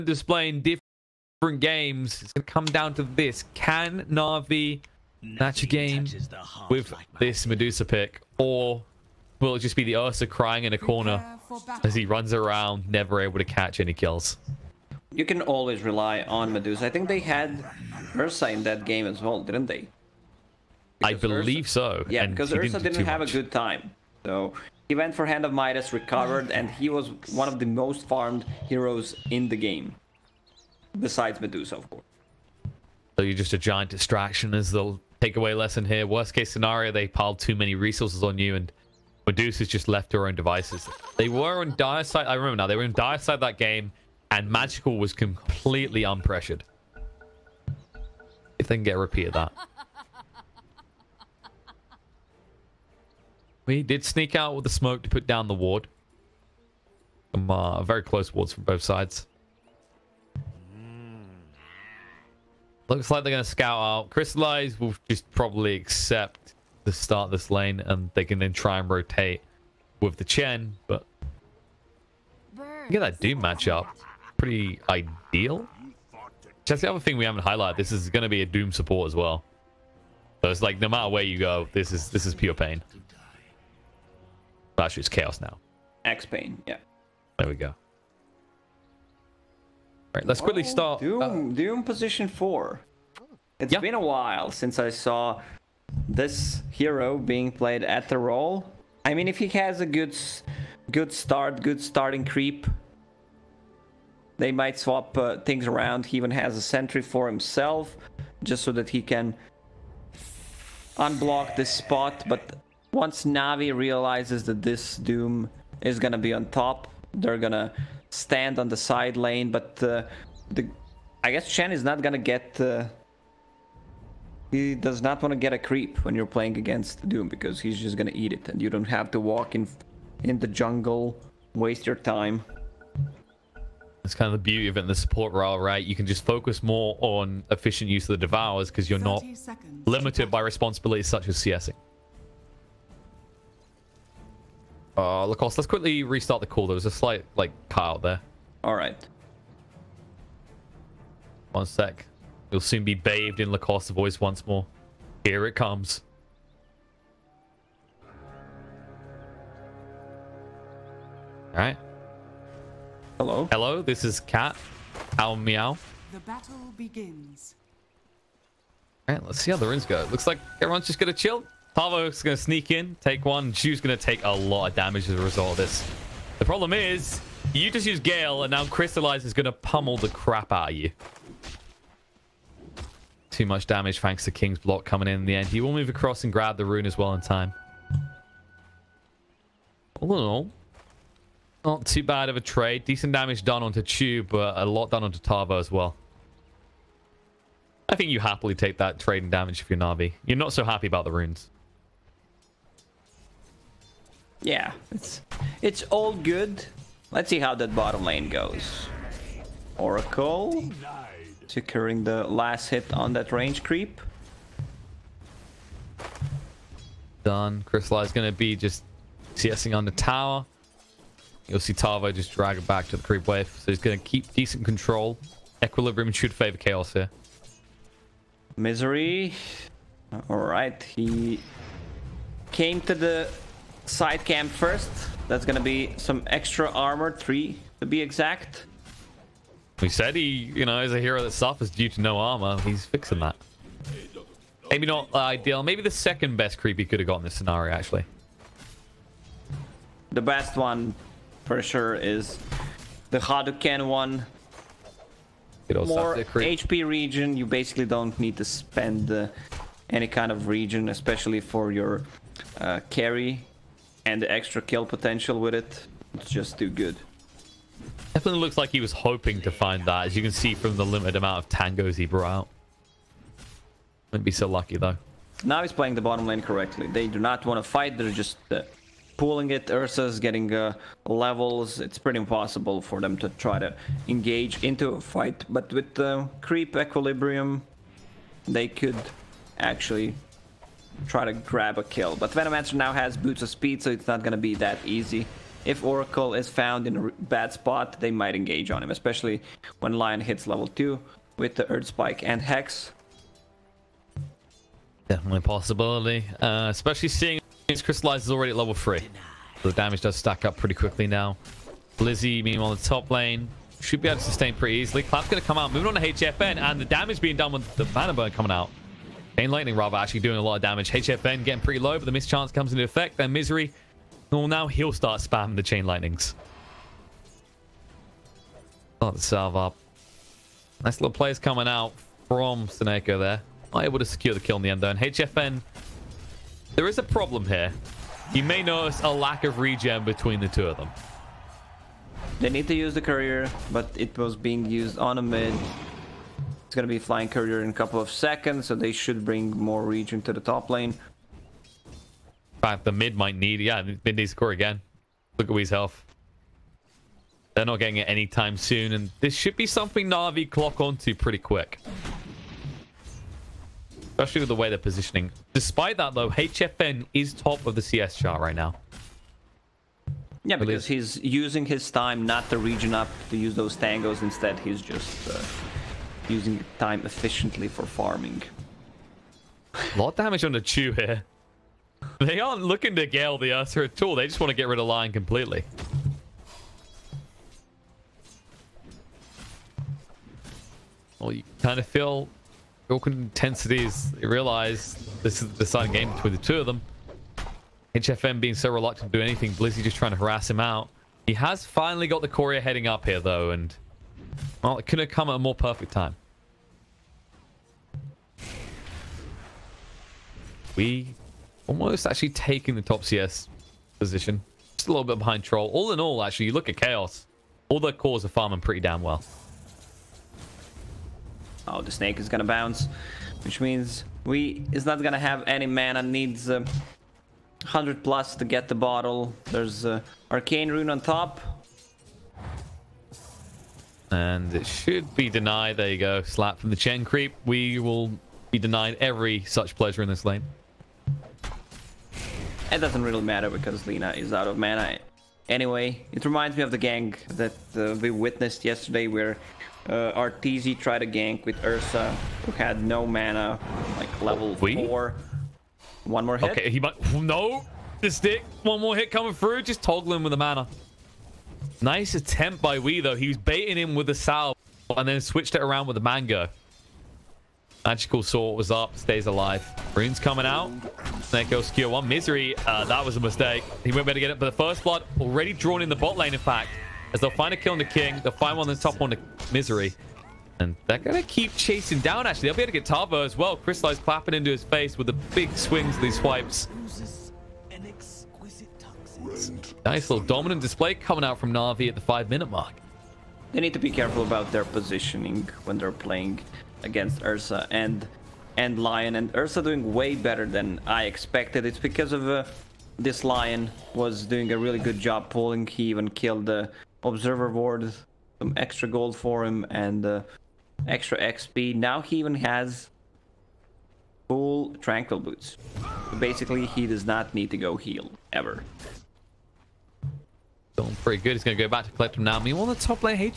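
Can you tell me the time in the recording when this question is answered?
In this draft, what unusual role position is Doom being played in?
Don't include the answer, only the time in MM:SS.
01:31.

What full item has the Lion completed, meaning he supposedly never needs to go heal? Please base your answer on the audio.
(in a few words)
Tranquil Boots.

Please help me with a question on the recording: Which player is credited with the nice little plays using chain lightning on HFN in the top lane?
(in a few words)
SoNNeikO.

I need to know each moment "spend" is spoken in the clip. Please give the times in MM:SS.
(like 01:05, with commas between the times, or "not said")
04:18.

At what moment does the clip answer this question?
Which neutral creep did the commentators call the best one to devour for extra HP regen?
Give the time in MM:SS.
04:13.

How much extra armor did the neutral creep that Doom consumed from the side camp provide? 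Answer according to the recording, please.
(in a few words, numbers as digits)
3.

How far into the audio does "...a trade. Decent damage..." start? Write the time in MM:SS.
03:12.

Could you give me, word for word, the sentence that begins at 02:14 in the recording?
That's kind of the beauty of it in the support role, right?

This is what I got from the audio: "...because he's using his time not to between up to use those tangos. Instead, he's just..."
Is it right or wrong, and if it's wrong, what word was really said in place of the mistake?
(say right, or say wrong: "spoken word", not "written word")
wrong: "regen", not "between".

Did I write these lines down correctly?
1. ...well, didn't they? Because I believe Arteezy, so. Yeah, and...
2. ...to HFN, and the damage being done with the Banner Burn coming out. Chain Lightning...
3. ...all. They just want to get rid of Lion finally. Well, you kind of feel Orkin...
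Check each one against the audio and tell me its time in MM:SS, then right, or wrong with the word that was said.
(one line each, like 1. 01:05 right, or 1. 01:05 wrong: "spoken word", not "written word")
1. 00:19 wrong: "Ursa", not "Arteezy"
2. 05:16 right
3. 06:24 wrong: "completely", not "finally".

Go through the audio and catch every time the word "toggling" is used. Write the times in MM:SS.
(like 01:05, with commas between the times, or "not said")
07:39.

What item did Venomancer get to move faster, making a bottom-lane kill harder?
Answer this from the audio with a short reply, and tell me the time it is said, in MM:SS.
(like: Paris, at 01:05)
Boots of speed, at 04:53.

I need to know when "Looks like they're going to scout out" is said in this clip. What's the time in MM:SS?
01:02.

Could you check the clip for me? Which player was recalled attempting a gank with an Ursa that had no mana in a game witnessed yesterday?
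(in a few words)
Arteezy.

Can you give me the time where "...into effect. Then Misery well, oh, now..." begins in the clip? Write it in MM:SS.
05:22.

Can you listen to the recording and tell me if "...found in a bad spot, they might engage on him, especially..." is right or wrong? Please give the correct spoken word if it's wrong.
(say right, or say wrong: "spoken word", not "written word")
right.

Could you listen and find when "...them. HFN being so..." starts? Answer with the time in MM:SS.
06:36.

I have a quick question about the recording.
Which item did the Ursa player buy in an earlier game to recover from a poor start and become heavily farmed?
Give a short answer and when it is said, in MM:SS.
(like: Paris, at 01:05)
Hand of Midas, at 00:25.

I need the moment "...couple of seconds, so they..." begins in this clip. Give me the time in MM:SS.
05:47.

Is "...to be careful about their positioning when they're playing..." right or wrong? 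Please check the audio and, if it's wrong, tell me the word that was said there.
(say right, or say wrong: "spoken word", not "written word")
right.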